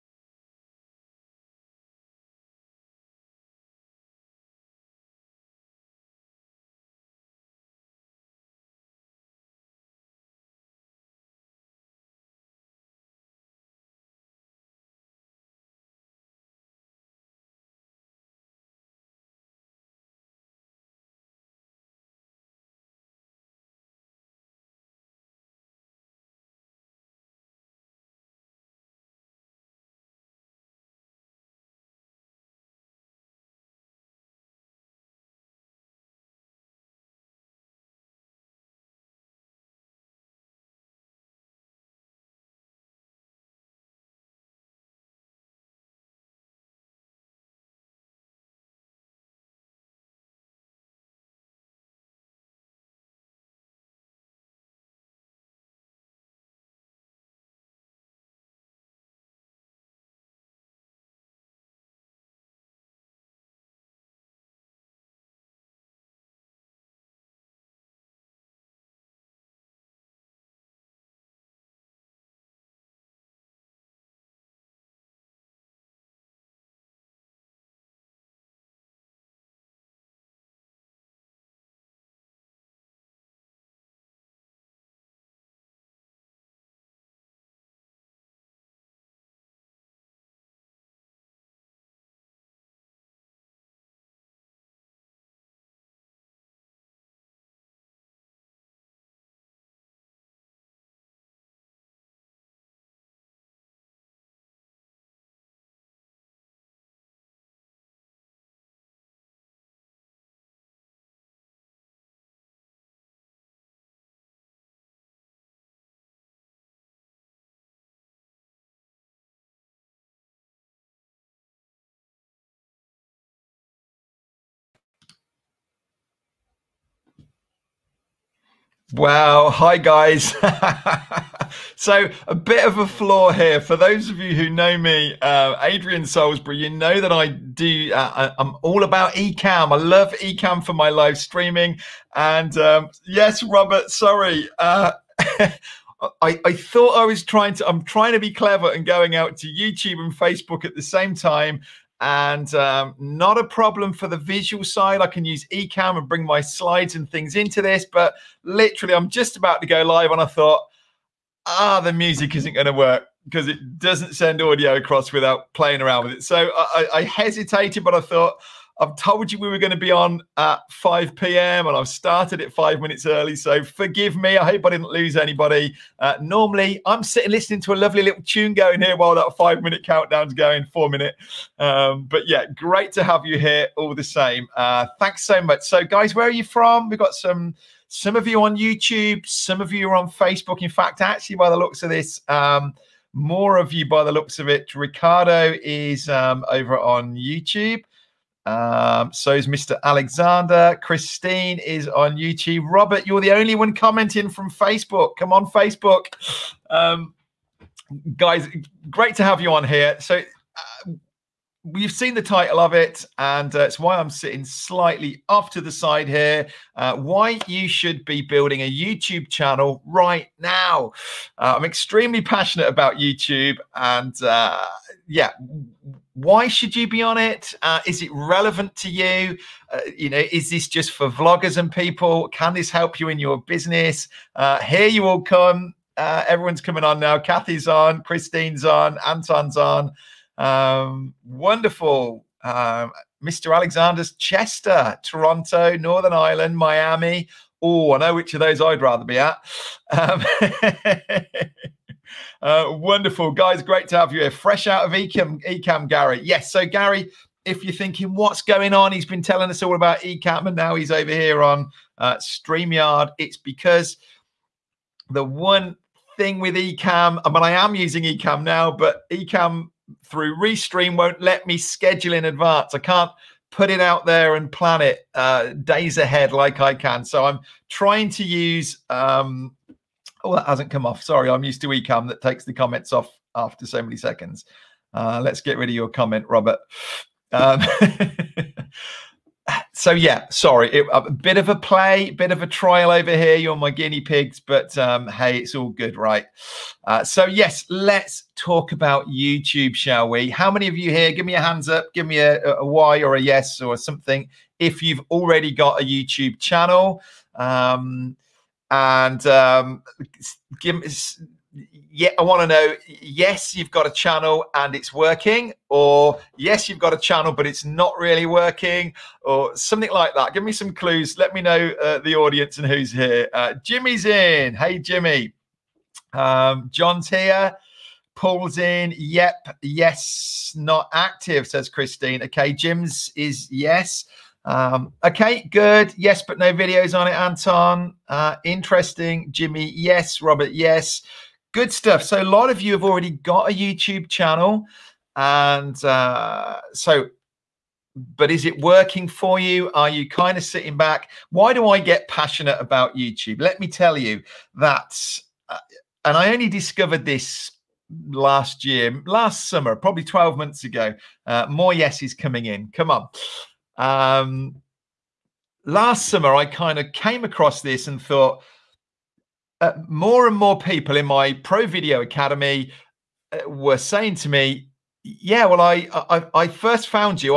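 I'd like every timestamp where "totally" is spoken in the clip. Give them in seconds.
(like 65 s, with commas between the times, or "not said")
not said.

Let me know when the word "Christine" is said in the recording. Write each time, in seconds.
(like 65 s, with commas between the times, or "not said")
200 s, 238 s, 331 s.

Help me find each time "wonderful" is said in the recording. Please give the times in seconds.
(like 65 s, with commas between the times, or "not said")
241 s, 252 s.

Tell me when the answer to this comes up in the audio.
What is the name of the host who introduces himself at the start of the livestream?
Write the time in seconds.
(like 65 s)
135 s.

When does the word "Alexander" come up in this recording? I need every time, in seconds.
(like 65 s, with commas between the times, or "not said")
199 s, 243 s.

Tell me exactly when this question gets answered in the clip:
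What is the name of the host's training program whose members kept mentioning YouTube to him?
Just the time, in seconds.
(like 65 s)
371 s.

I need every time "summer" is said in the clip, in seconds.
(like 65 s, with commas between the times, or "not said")
359 s, 366 s.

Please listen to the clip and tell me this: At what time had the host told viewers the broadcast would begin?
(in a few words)
5 p.m.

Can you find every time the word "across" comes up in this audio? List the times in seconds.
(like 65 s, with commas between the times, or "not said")
164 s, 367 s.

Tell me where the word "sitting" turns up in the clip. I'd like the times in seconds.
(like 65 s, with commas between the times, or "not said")
177 s, 214 s, 350 s.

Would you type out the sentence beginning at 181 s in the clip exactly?
Um, but yeah, great to have you here all the same.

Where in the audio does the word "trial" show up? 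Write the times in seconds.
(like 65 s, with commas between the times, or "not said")
292 s.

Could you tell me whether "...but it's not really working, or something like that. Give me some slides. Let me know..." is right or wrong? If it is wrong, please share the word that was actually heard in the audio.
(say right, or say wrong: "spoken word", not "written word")
wrong: "clues", not "slides".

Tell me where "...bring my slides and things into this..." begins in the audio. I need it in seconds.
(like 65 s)
156 s.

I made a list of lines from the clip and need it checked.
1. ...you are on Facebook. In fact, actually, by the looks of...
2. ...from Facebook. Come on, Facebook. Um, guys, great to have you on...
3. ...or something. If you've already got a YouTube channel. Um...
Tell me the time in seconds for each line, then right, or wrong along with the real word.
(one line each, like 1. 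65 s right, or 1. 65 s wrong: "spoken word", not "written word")
1. 189 s right
2. 204 s right
3. 303 s right.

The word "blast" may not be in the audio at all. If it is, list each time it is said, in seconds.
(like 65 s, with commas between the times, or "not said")
not said.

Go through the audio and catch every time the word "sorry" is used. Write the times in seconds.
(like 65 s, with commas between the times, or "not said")
143 s, 281 s, 290 s.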